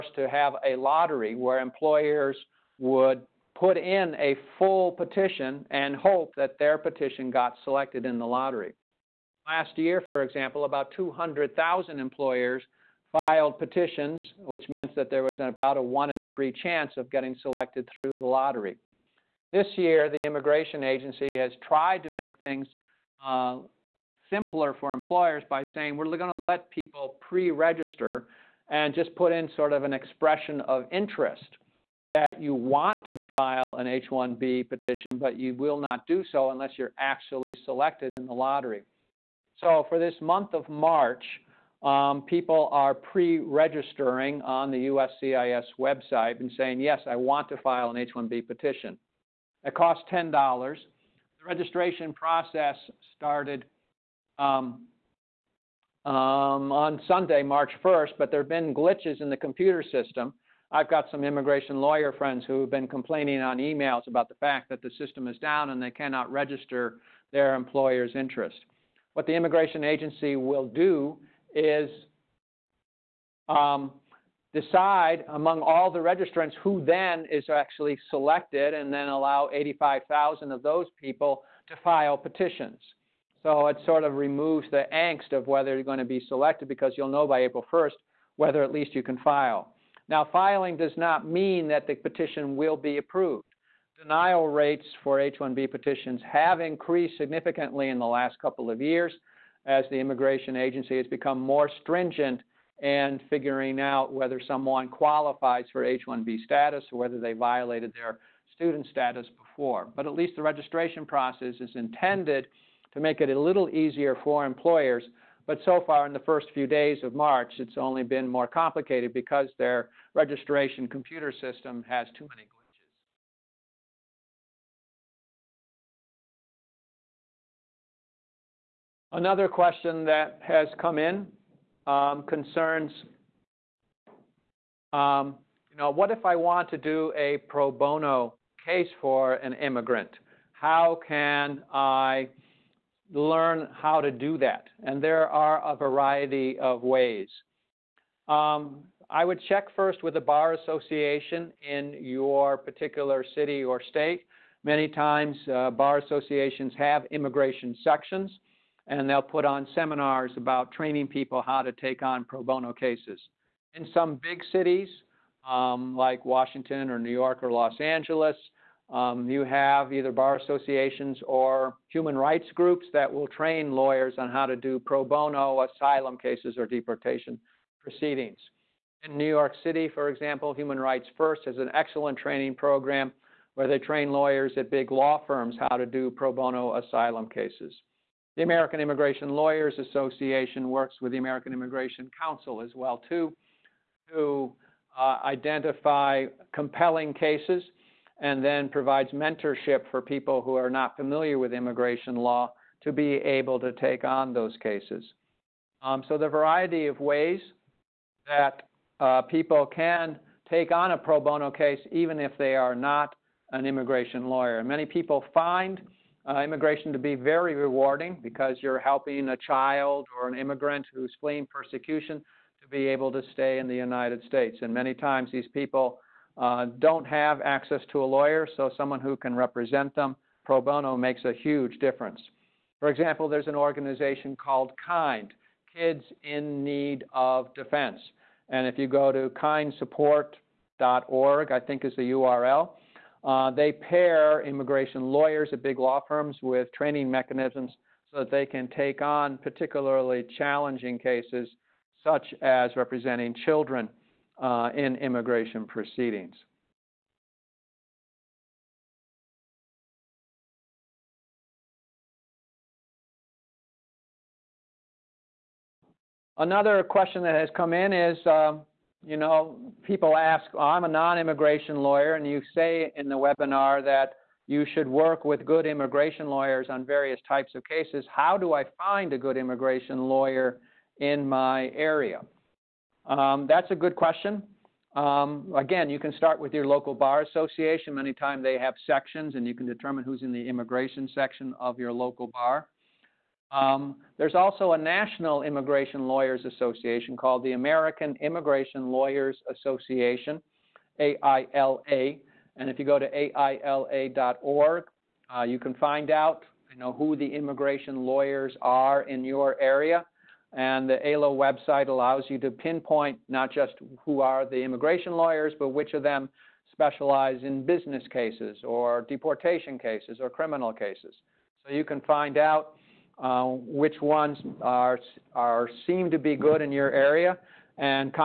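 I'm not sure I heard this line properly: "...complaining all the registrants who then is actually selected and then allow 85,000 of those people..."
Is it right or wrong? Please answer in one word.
wrong.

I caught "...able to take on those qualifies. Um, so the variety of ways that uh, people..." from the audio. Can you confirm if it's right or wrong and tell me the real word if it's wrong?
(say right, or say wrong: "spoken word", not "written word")
wrong: "cases", not "qualifies".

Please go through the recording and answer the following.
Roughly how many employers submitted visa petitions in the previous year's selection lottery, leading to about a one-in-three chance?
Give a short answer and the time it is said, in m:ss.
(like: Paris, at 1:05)
200,000, at 0:10.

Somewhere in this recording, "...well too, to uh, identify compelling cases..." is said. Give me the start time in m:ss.
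3:12.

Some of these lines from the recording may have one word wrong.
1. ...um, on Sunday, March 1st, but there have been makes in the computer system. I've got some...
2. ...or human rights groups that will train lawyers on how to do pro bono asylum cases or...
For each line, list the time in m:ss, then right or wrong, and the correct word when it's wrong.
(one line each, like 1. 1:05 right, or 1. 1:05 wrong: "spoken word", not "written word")
1. 0:56 wrong: "glitches", not "makes"
2. 2:51 right.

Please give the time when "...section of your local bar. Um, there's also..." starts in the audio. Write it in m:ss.
4:51.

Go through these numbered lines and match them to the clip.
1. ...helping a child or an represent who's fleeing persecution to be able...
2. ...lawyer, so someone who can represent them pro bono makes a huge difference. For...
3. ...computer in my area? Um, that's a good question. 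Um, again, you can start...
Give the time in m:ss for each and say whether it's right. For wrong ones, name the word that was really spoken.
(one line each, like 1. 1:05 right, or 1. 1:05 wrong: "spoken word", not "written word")
1. 3:38 wrong: "immigrant", not "represent"
2. 3:48 right
3. 4:40 wrong: "lawyer", not "computer".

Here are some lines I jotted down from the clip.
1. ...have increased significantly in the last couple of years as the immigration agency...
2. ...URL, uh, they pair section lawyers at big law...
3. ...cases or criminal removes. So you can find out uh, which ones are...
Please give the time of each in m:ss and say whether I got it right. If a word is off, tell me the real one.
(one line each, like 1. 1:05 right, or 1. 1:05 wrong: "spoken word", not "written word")
1. 1:36 right
2. 4:02 wrong: "immigration", not "section"
3. 5:19 wrong: "cases", not "removes".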